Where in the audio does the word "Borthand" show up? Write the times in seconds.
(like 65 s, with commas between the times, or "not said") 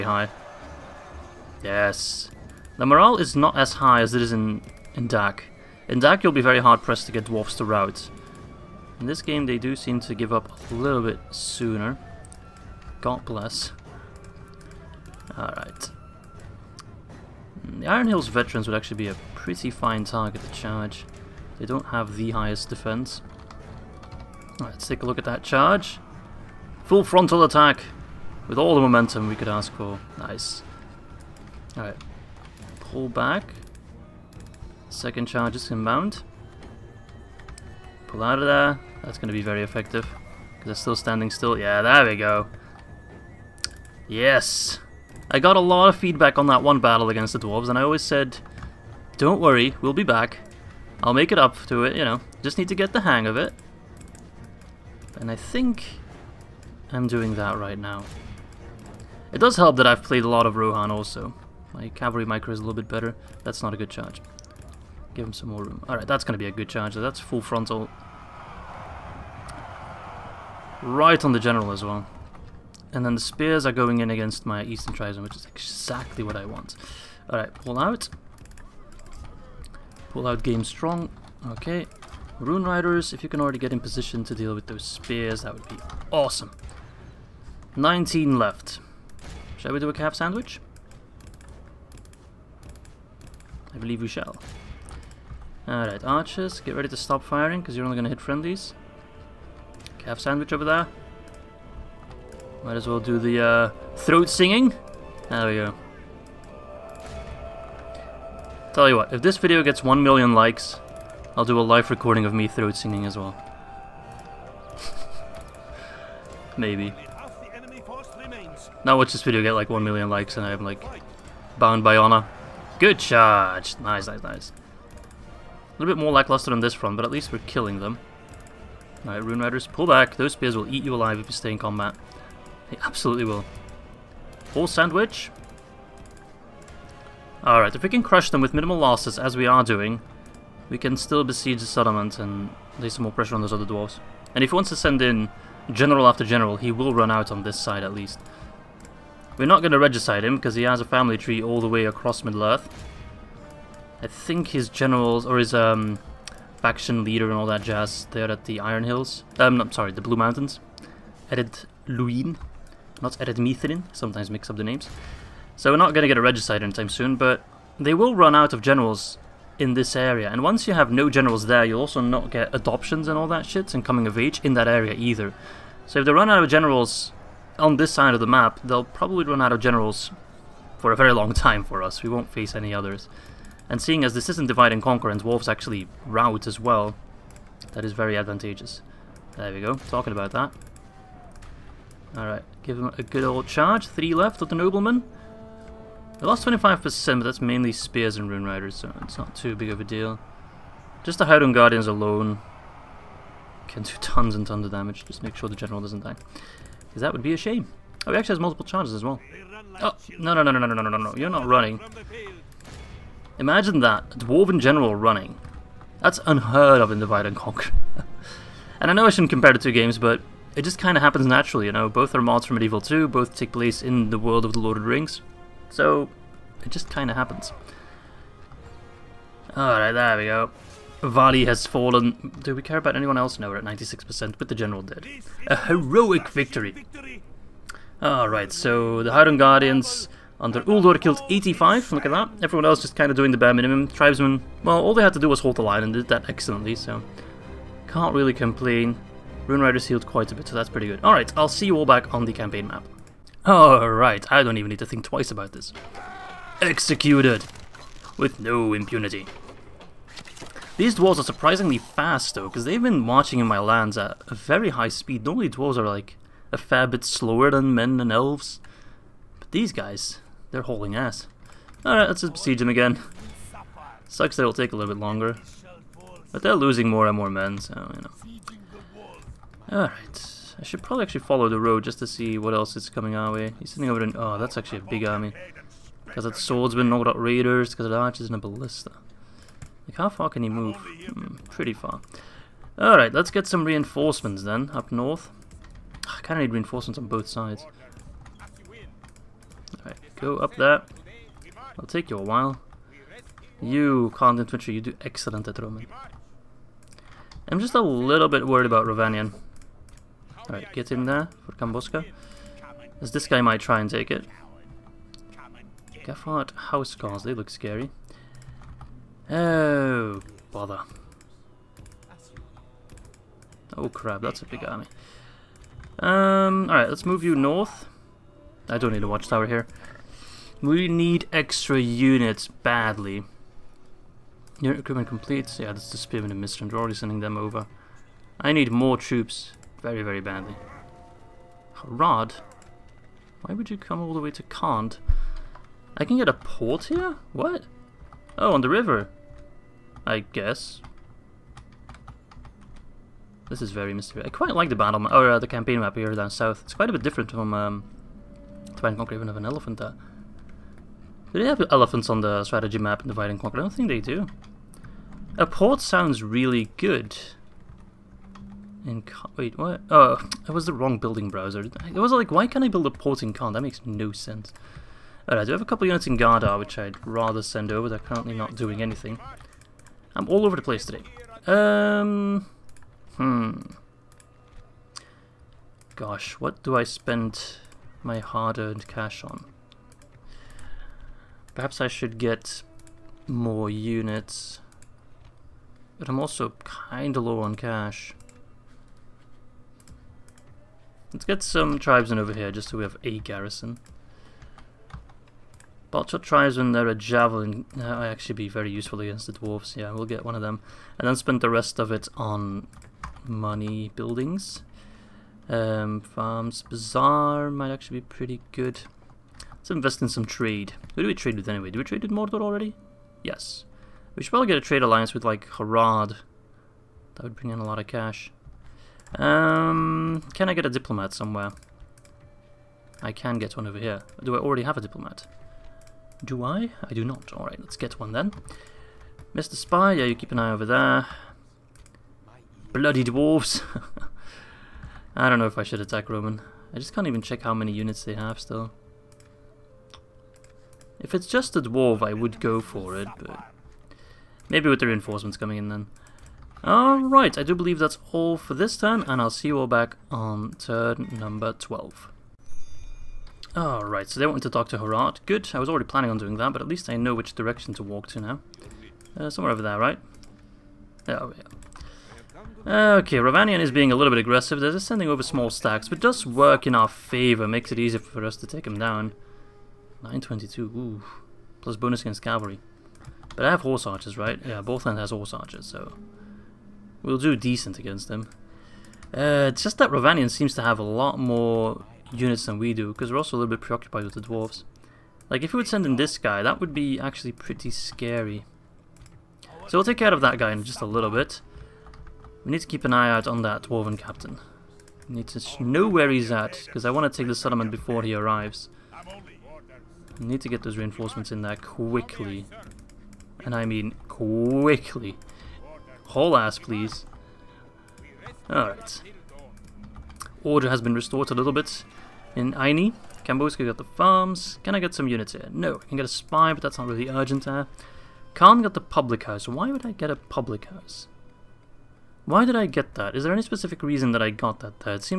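484 s.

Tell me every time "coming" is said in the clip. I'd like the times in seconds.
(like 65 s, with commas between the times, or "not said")
173 s, 282 s, 455 s.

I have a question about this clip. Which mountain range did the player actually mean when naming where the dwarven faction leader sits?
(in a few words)
Luin.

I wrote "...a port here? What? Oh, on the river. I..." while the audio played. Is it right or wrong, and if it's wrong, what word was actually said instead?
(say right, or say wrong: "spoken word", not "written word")
right.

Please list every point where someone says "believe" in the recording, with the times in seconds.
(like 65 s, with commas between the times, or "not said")
93 s, 457 s.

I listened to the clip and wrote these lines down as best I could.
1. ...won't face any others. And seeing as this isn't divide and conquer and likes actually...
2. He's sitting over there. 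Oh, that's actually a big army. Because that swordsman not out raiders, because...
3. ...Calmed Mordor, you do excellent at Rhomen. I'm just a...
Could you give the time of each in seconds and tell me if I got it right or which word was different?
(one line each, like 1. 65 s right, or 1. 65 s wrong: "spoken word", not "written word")
1. 182 s wrong: "dwarves", not "likes"
2. 283 s right
3. 304 s wrong: "Infantry", not "Mordor".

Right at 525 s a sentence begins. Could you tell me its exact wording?
No, I can get a spy, but that's not really urgent there.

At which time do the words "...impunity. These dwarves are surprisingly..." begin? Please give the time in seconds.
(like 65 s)
258 s.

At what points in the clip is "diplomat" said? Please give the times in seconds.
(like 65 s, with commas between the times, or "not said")
430 s, 434 s.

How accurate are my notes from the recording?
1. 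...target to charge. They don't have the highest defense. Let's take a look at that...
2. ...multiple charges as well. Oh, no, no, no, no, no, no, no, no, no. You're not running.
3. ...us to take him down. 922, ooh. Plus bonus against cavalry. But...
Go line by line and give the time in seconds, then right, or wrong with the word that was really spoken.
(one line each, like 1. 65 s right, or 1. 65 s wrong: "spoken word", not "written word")
1. 20 s right
2. 208 s right
3. 478 s right.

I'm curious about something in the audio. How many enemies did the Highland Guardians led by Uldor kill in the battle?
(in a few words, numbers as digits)
85.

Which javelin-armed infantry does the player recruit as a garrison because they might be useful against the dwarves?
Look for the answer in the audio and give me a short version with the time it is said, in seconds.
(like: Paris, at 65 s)
Balchoth tribesmen, at 405 s.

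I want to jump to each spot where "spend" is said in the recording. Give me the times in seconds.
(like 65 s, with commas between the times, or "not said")
386 s, 411 s.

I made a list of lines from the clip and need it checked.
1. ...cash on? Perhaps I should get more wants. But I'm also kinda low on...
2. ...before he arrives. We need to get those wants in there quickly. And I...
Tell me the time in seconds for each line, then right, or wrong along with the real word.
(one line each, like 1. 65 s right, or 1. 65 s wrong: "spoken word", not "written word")
1. 388 s wrong: "units", not "wants"
2. 507 s wrong: "reinforcements", not "wants".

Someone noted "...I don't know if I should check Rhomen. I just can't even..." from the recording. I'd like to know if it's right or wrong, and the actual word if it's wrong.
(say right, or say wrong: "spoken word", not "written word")
wrong: "attack", not "check".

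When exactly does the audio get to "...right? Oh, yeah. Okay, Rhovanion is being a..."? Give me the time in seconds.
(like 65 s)
469 s.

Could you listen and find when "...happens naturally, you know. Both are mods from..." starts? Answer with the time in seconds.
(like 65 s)
221 s.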